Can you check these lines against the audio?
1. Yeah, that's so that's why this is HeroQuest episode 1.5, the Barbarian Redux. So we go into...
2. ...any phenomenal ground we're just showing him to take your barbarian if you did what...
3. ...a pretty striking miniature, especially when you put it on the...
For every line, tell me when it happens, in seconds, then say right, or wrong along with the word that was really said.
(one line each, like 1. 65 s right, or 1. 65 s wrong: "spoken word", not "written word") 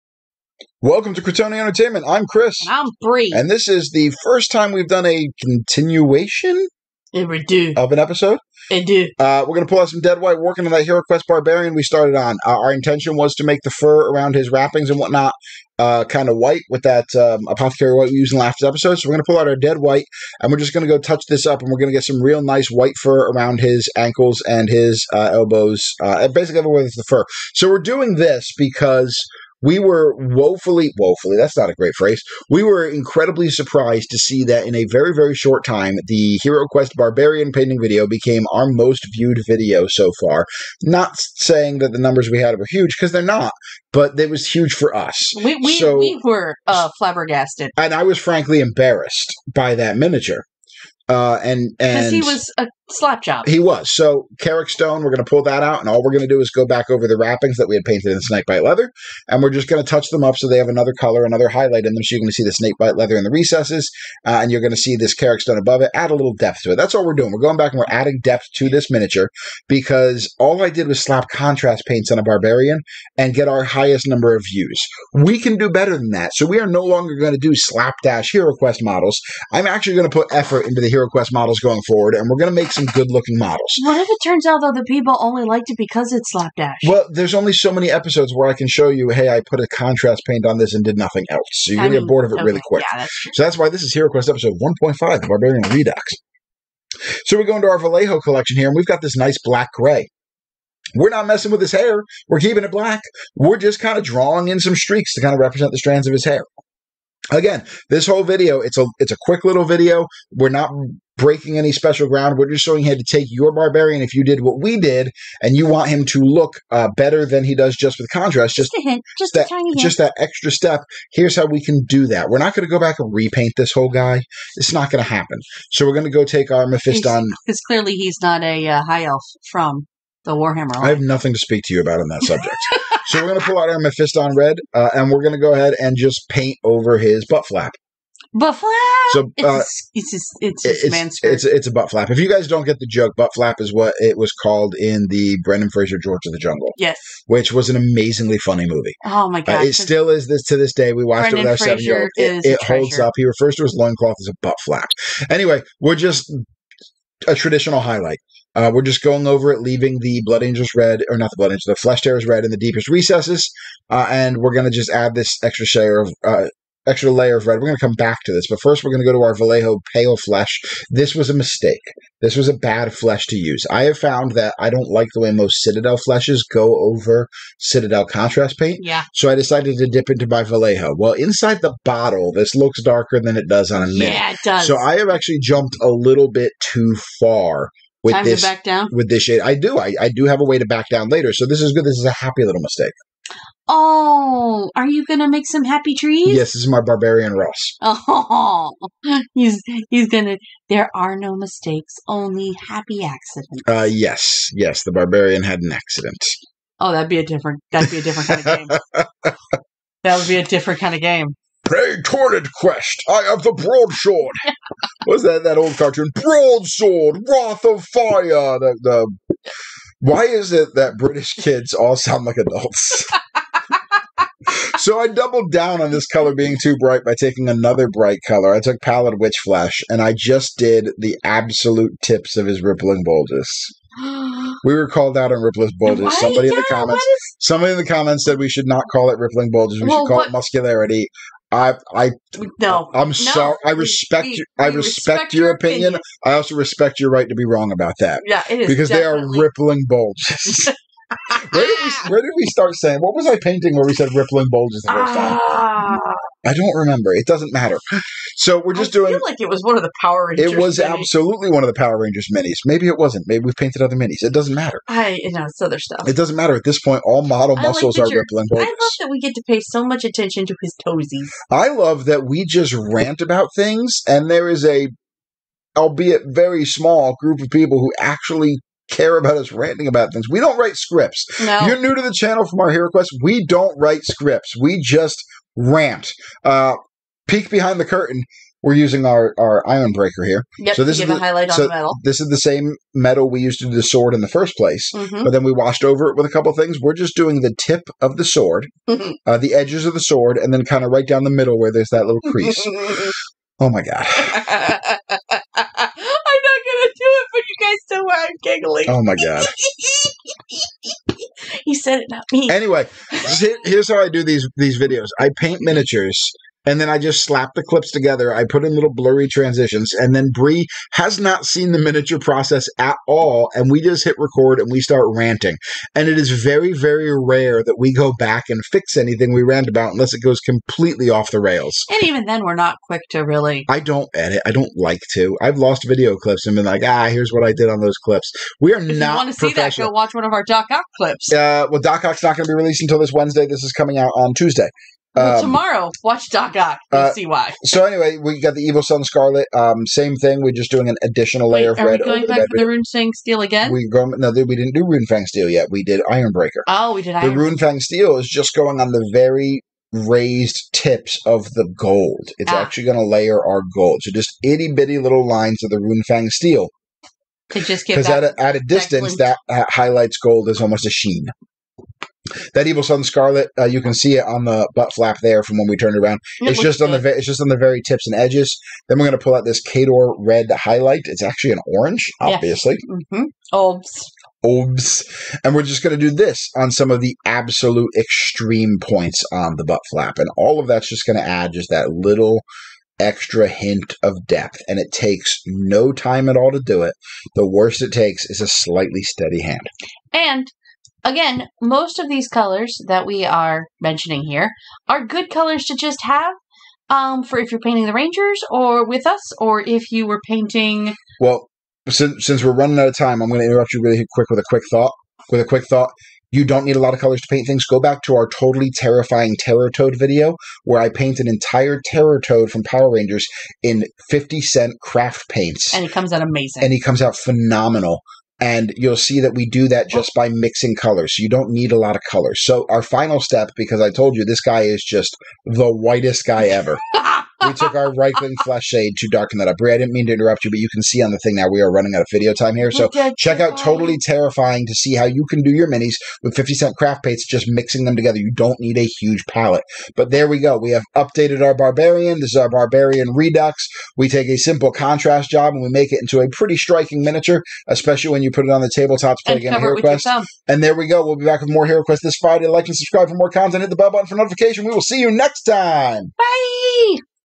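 1. 92 s right
2. 111 s wrong: "special", not "phenomenal"
3. 456 s right.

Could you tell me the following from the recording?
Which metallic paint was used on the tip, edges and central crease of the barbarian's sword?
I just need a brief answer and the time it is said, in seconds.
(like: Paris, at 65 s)
Ironbreaker, at 289 s.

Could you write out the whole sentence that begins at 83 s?
What if it turns out though the people only liked it because it's slapdash?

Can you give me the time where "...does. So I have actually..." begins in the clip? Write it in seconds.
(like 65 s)
184 s.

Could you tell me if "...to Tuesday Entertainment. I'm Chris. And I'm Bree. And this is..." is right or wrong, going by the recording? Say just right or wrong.
wrong.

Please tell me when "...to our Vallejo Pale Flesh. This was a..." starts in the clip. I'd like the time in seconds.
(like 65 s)
169 s.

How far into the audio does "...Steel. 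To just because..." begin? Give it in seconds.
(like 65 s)
366 s.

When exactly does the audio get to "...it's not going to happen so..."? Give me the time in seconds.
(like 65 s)
124 s.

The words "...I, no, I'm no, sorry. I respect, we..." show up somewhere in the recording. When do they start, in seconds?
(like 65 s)
241 s.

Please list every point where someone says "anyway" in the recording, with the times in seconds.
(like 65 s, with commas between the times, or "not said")
155 s, 312 s, 347 s.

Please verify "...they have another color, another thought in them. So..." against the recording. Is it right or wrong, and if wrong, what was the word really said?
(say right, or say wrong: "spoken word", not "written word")
wrong: "highlight", not "thought".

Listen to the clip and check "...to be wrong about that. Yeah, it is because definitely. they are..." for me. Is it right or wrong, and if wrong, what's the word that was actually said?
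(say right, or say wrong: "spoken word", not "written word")
right.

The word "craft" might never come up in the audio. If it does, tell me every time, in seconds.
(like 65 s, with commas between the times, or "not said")
424 s, 446 s.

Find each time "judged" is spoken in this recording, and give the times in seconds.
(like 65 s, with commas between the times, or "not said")
not said.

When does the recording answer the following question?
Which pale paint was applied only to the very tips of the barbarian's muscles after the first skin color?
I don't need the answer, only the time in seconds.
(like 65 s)
228 s.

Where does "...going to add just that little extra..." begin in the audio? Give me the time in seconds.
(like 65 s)
391 s.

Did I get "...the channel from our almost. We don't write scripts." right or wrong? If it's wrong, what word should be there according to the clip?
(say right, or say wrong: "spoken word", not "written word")
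wrong: "quest", not "almost".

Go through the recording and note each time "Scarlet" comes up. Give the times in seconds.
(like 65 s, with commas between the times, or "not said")
349 s, 373 s.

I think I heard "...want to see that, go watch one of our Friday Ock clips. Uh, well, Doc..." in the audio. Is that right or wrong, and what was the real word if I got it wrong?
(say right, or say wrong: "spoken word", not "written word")
wrong: "Doc", not "Friday".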